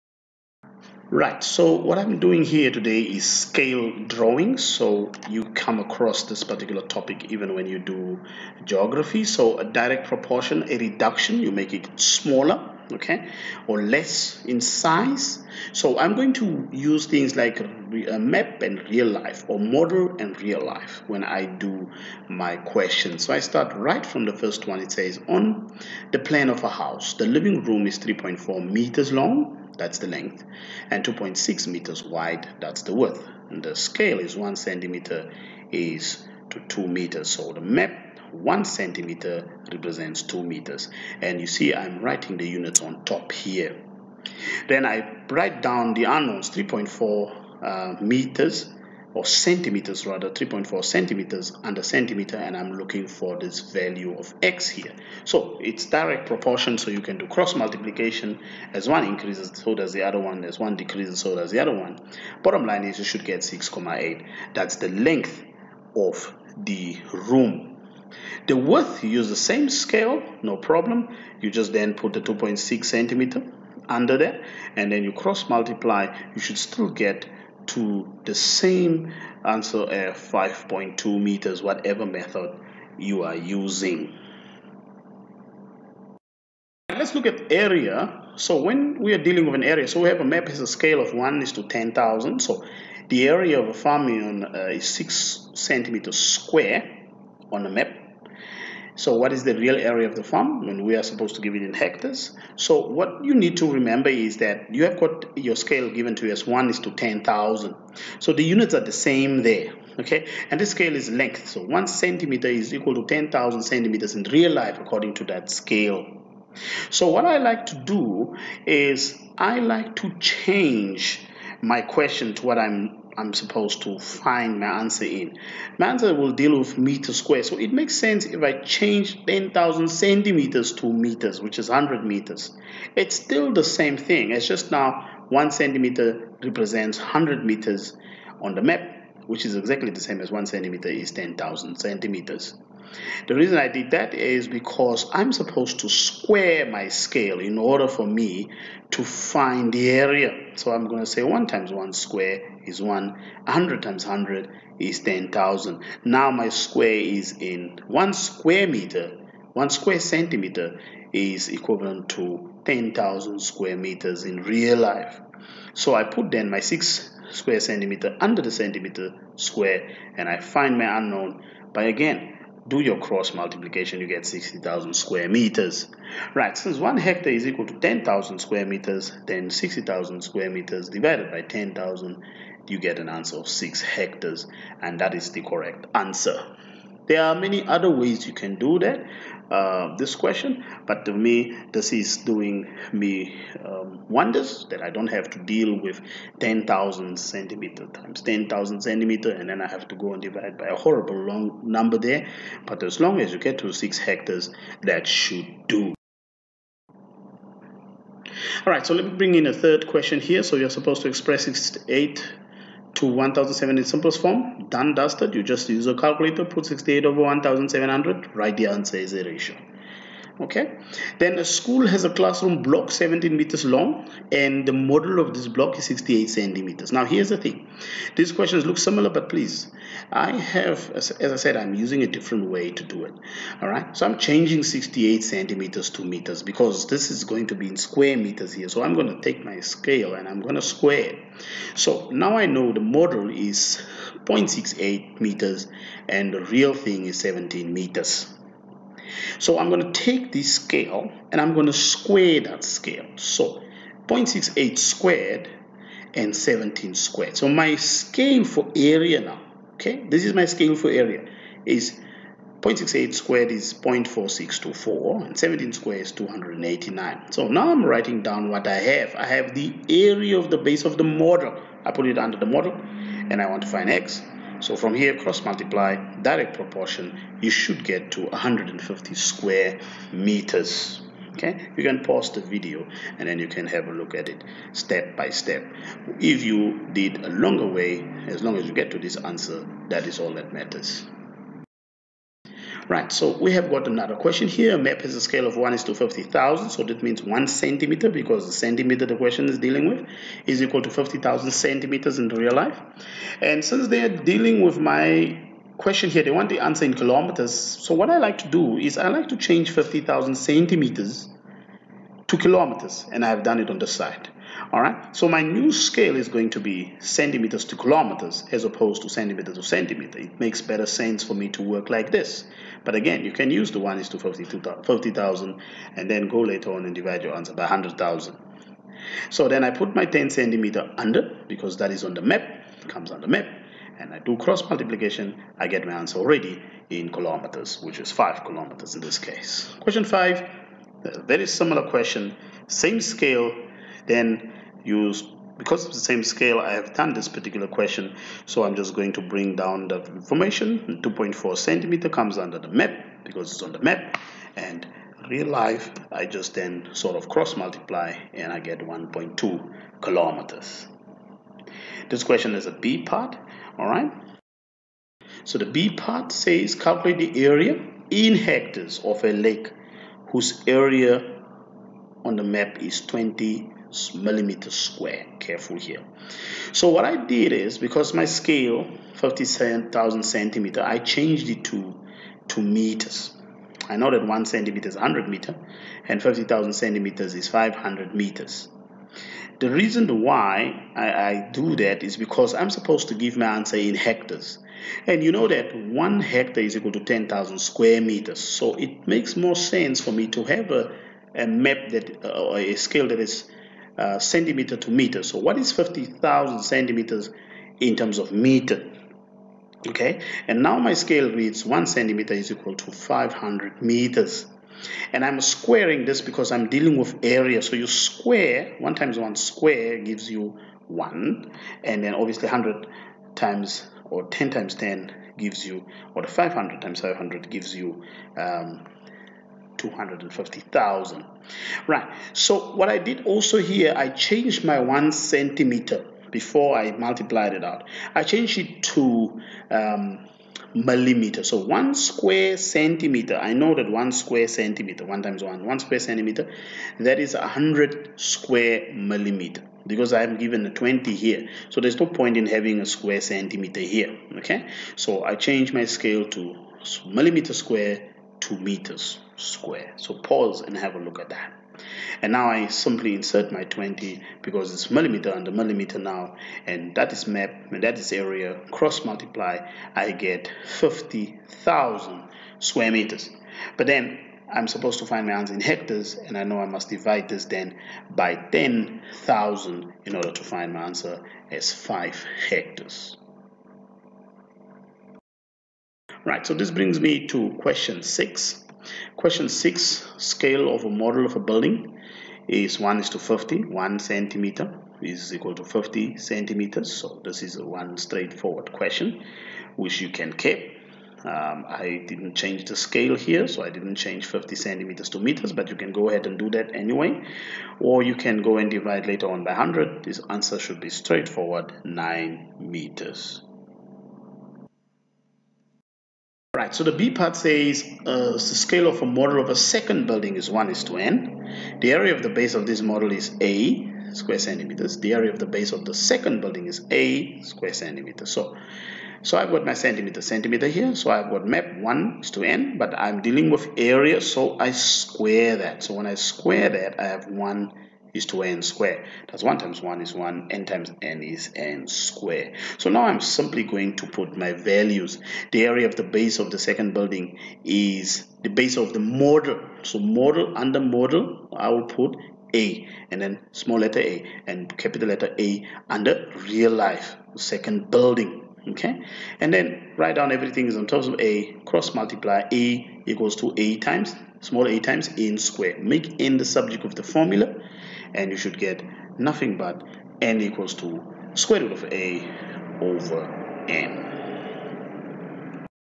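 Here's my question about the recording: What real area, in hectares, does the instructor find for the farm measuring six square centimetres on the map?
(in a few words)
6 hectares.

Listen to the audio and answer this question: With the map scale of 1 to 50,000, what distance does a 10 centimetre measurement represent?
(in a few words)
5 kilometers.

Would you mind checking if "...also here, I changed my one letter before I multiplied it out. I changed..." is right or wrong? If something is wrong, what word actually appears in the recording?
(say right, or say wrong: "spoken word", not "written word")
wrong: "centimeter", not "letter".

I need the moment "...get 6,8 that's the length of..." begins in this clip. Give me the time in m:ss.
1:03.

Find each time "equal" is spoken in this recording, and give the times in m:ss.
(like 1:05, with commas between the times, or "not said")
1:52, 2:57, 5:00, 6:36, 6:52, 8:15, 9:23, 9:30.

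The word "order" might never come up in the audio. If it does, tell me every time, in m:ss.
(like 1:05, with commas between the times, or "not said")
2:27, 8:00.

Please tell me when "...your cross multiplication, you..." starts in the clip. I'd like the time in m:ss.
2:52.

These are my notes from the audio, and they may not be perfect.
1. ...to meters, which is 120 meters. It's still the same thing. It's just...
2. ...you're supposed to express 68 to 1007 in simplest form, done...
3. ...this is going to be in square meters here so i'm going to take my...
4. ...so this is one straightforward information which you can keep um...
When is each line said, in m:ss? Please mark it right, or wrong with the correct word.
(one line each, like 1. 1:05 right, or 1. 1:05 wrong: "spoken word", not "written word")
1. 2:10 wrong: "100", not "120"
2. 3:30 right
3. 3:56 right
4. 8:16 wrong: "question", not "information".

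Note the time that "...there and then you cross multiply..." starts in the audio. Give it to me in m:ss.
1:14.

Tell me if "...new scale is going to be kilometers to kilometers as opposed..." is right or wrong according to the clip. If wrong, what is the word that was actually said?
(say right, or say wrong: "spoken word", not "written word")
wrong: "centimeters", not "kilometers".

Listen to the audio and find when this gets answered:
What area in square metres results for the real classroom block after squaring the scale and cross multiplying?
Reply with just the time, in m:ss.
4:38.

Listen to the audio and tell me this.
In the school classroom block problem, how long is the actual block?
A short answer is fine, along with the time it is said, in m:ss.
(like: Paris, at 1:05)
17 meters, at 3:42.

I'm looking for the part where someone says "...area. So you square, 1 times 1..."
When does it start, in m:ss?
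6:57.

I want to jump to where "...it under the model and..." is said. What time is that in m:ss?
4:32.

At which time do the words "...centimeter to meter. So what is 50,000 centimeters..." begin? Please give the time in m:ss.
6:44.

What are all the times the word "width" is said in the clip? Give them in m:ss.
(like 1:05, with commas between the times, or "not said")
0:32, 1:08.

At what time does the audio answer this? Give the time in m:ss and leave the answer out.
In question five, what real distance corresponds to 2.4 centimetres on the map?
5:58.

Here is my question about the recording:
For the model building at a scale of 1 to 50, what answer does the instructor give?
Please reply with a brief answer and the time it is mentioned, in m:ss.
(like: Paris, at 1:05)
9 meters, at 8:31.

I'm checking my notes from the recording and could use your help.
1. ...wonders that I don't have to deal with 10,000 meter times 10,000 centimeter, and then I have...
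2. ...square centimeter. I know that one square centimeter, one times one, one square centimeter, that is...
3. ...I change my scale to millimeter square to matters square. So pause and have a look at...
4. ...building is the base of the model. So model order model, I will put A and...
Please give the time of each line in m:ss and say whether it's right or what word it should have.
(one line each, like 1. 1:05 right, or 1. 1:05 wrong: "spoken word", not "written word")
1. 3:14 wrong: "centimeter", not "meter"
2. 7:21 right
3. 7:35 wrong: "meters", not "matters"
4. 9:06 wrong: "under", not "order".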